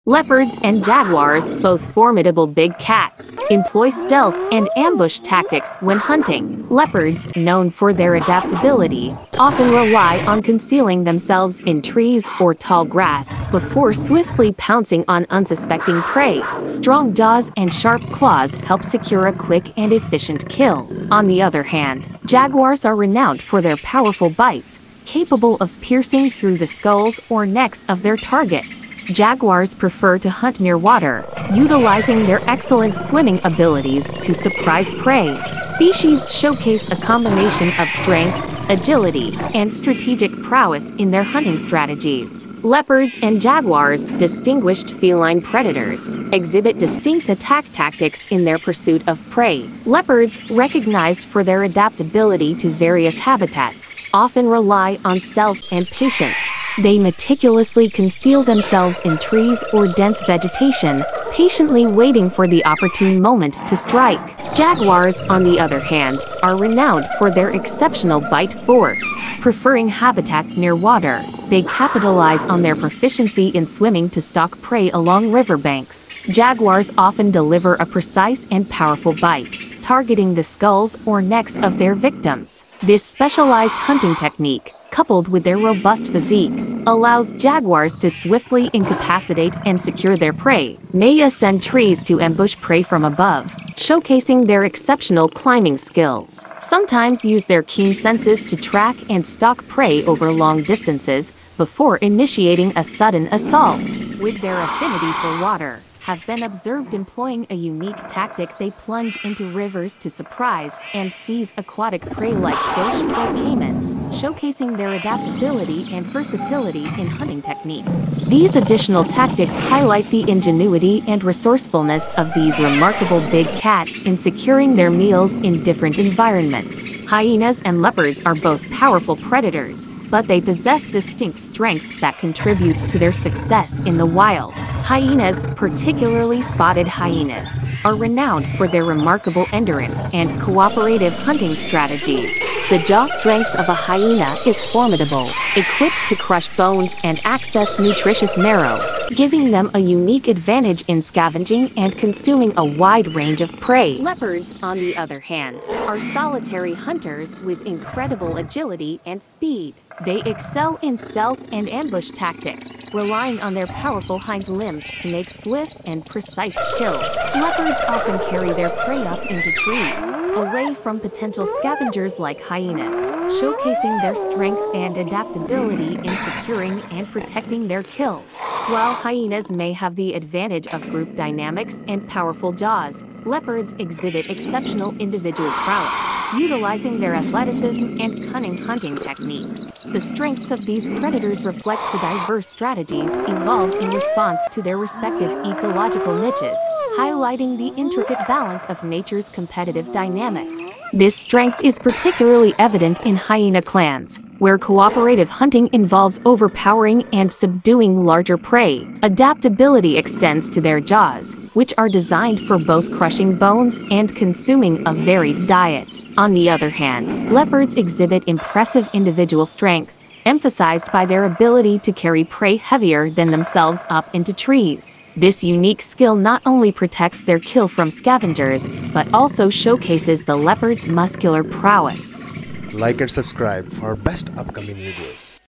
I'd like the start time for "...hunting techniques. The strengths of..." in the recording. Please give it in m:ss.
3:08.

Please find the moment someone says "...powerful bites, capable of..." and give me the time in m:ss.
0:23.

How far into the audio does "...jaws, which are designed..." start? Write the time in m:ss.
3:30.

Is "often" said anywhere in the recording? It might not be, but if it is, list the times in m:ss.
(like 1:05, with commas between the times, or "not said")
0:09, 0:54, 1:16, 2:47.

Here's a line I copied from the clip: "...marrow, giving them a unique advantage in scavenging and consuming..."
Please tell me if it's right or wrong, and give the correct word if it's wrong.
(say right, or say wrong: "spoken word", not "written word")
right.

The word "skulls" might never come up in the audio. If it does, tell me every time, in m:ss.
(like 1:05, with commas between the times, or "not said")
0:26, 1:20.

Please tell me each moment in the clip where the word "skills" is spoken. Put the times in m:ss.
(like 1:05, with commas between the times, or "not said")
1:35, 3:45.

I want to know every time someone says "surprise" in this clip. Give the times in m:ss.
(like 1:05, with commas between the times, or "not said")
0:34, 1:50.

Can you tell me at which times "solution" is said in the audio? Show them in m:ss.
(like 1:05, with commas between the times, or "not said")
not said.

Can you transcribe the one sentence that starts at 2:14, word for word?
Hyenas, particularly spotted hyenas, are renowned for their remarkable endurance and cooperative hunting strategies.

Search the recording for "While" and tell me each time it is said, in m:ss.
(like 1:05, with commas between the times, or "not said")
2:58.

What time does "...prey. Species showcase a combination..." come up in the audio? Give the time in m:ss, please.
0:35.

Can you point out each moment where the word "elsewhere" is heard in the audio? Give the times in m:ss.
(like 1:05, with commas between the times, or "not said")
not said.